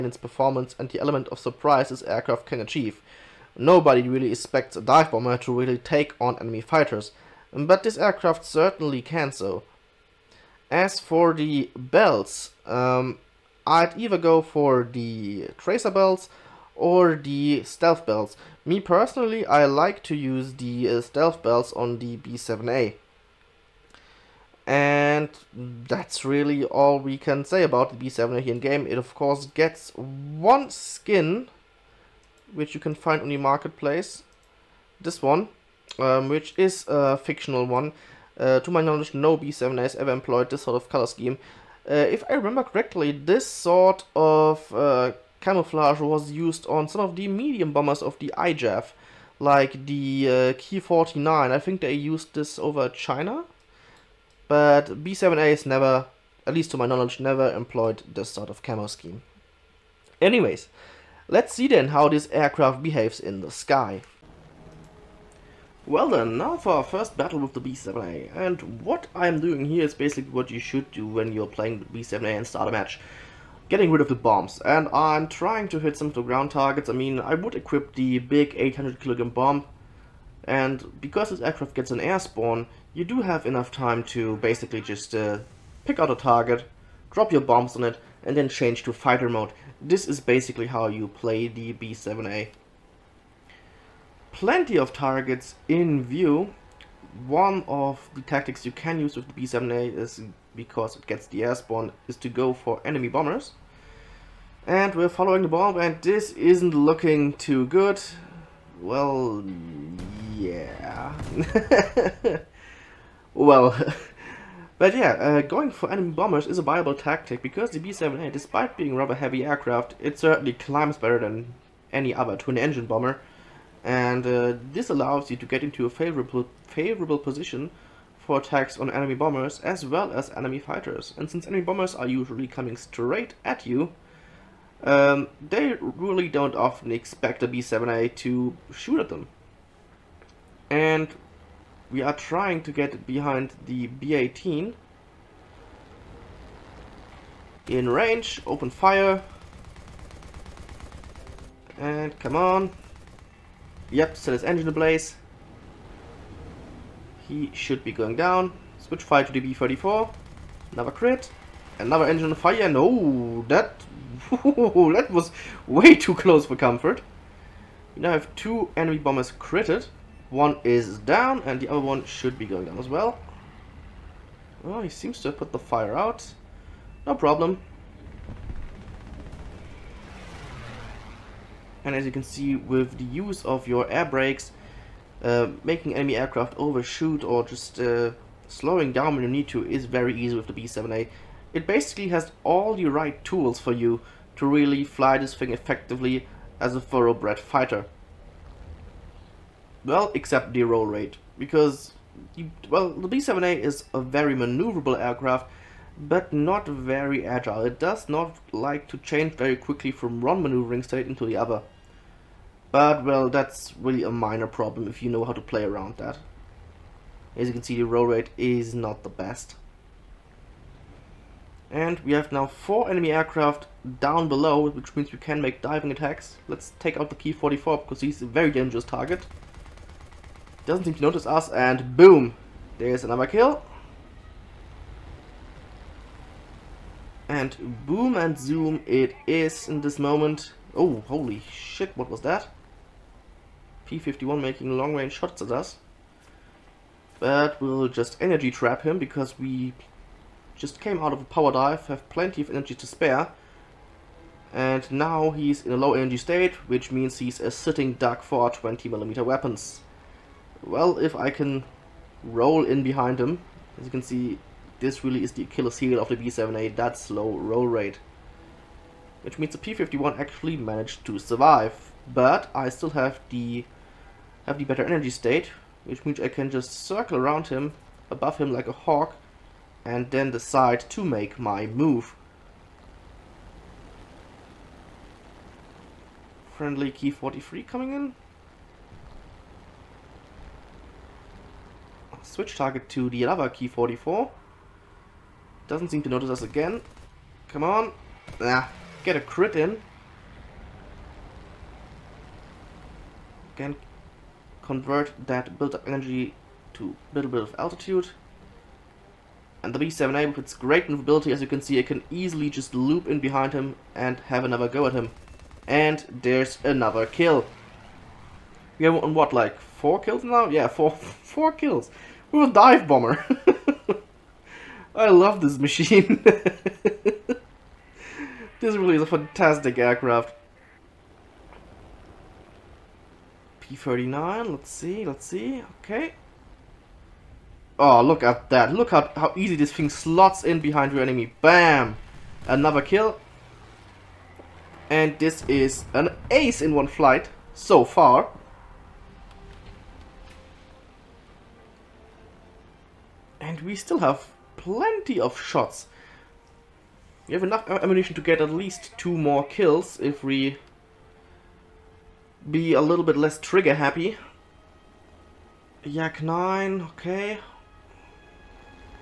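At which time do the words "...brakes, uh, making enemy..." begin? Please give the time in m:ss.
3:04.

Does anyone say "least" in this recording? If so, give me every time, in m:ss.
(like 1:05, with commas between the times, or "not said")
0:56, 5:58.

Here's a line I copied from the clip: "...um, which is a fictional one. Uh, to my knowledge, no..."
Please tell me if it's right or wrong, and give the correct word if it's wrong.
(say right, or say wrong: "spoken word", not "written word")
right.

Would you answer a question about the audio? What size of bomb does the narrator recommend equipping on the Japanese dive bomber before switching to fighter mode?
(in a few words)
800 kilograms.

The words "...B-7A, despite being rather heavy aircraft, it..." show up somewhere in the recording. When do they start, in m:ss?
1:57.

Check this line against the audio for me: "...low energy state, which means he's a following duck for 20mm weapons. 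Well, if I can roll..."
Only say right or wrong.
wrong.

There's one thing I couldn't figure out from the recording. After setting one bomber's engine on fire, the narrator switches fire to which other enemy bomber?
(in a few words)
B-34.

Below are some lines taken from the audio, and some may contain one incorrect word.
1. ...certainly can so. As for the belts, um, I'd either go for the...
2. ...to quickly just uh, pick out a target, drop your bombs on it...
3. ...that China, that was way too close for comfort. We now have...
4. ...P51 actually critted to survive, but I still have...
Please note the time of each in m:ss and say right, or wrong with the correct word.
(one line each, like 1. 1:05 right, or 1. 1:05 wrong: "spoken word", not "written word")
1. 0:08 right
2. 1:24 wrong: "basically", not "quickly"
3. 2:43 wrong: "Ooh", not "China"
4. 4:29 wrong: "managed", not "critted".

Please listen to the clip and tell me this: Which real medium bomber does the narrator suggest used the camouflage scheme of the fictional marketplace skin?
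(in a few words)
Ki-49.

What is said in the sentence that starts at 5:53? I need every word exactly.
And we still have plenty of shots.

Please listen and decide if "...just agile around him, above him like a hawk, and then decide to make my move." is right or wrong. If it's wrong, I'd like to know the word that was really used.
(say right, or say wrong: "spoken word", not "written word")
wrong: "circle", not "agile".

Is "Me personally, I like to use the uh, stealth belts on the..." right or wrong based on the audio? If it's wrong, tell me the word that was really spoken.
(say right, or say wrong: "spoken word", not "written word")
right.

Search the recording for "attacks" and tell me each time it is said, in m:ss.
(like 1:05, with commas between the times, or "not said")
2:08, 3:45.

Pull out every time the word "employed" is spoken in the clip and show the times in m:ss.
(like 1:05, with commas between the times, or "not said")
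0:40, 0:57.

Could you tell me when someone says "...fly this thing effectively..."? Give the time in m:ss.
3:14.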